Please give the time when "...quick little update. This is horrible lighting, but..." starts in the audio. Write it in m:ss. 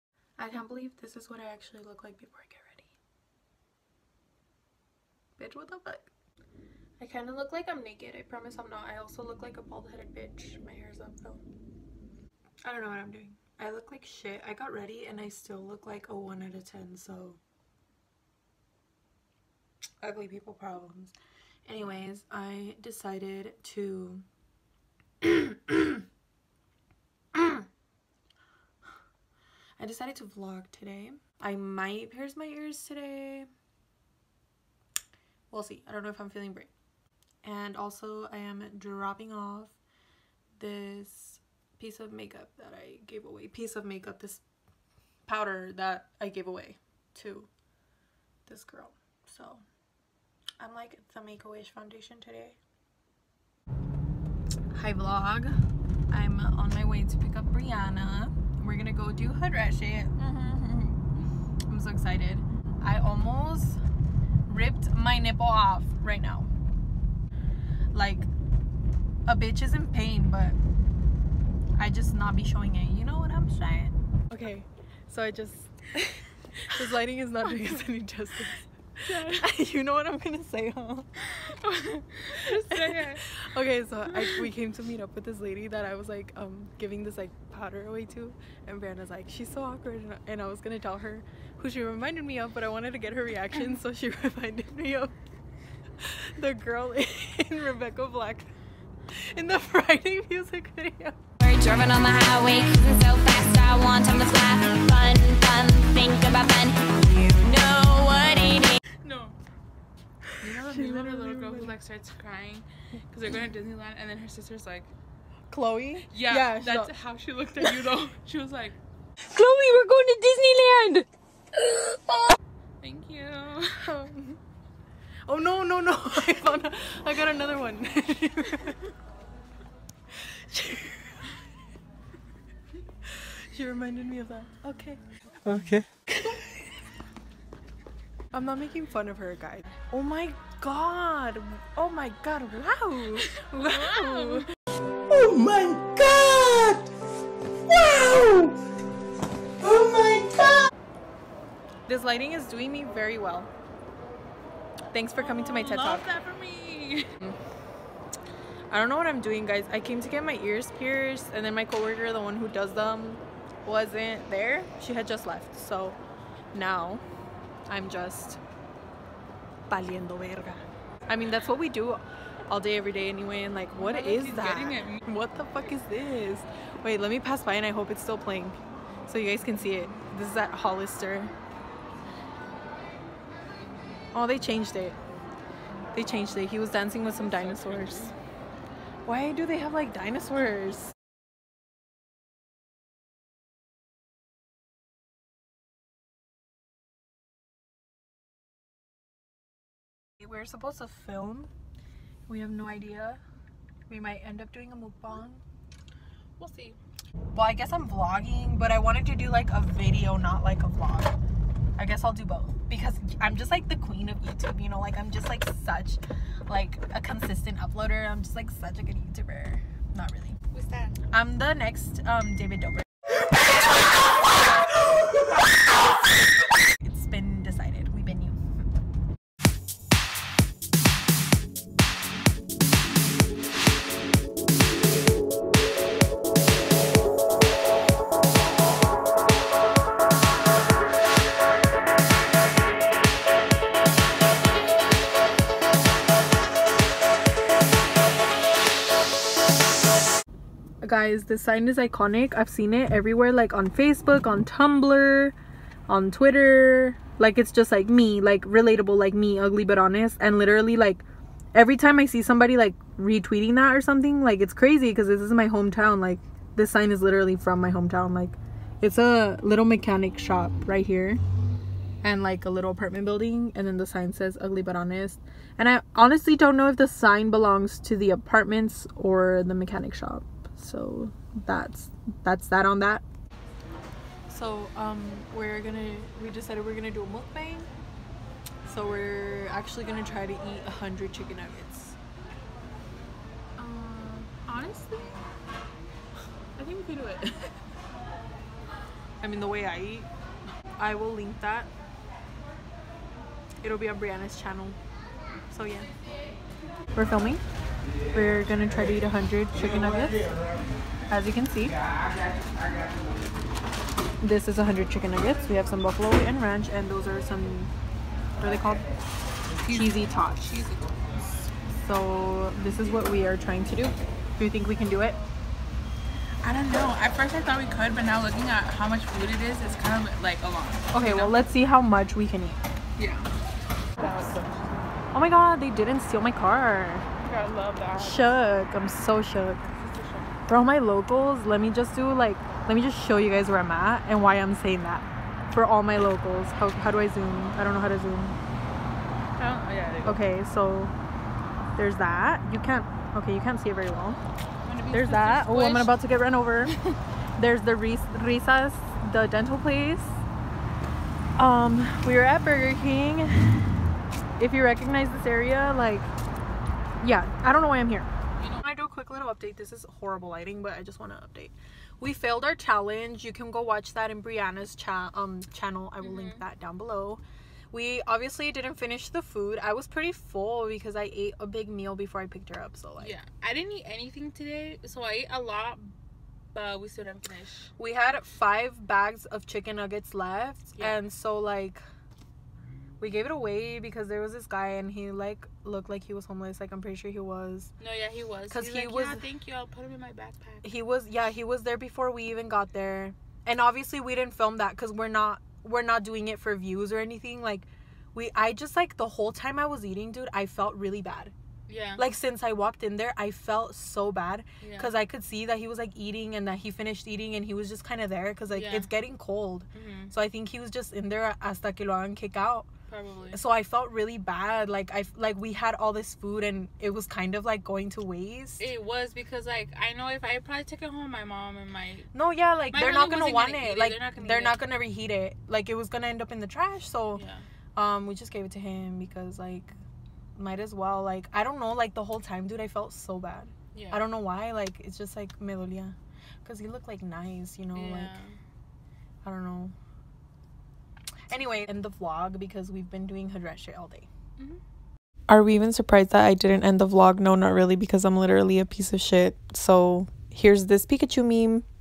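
6:08.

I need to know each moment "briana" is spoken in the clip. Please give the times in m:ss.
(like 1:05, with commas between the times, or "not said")
0:57, 1:28, 5:03, 6:14.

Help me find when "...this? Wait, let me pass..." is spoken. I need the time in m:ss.
2:55.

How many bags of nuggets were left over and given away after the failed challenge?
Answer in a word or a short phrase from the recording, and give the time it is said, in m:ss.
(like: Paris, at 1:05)
5, at 6:28.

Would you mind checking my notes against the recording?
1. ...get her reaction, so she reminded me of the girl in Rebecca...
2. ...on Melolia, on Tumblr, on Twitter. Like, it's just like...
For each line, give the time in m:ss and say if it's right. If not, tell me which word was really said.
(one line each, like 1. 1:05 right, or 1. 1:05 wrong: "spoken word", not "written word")
1. 1:32 right
2. 4:13 wrong: "Facebook", not "Melolia".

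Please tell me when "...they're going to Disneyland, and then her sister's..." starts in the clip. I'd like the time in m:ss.
1:53.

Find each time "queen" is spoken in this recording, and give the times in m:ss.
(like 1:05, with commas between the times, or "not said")
3:33.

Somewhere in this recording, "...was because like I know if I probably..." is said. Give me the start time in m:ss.
7:08.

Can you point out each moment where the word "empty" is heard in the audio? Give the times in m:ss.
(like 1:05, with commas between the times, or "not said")
not said.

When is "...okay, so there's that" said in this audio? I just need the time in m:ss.
5:50.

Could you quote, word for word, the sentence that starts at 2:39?
I came to get my ears pierced, and then my coworker, the one who does them, wasn't there.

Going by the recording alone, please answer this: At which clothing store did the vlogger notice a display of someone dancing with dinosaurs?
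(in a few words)
Hollister.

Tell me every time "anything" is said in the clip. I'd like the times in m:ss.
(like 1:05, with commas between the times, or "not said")
6:23, 6:46.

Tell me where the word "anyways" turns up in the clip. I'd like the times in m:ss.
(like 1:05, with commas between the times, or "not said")
0:21, 2:53, 7:31.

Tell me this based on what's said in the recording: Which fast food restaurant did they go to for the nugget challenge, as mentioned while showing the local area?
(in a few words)
Burger King.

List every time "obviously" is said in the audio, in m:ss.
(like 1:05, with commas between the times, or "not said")
6:18, 6:43.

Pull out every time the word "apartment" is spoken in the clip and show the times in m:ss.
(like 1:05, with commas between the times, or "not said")
4:32, 4:38.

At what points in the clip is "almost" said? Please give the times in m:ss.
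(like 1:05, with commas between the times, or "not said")
1:02.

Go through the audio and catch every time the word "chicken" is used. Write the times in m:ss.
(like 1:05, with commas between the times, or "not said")
4:51, 5:09, 5:14, 6:29.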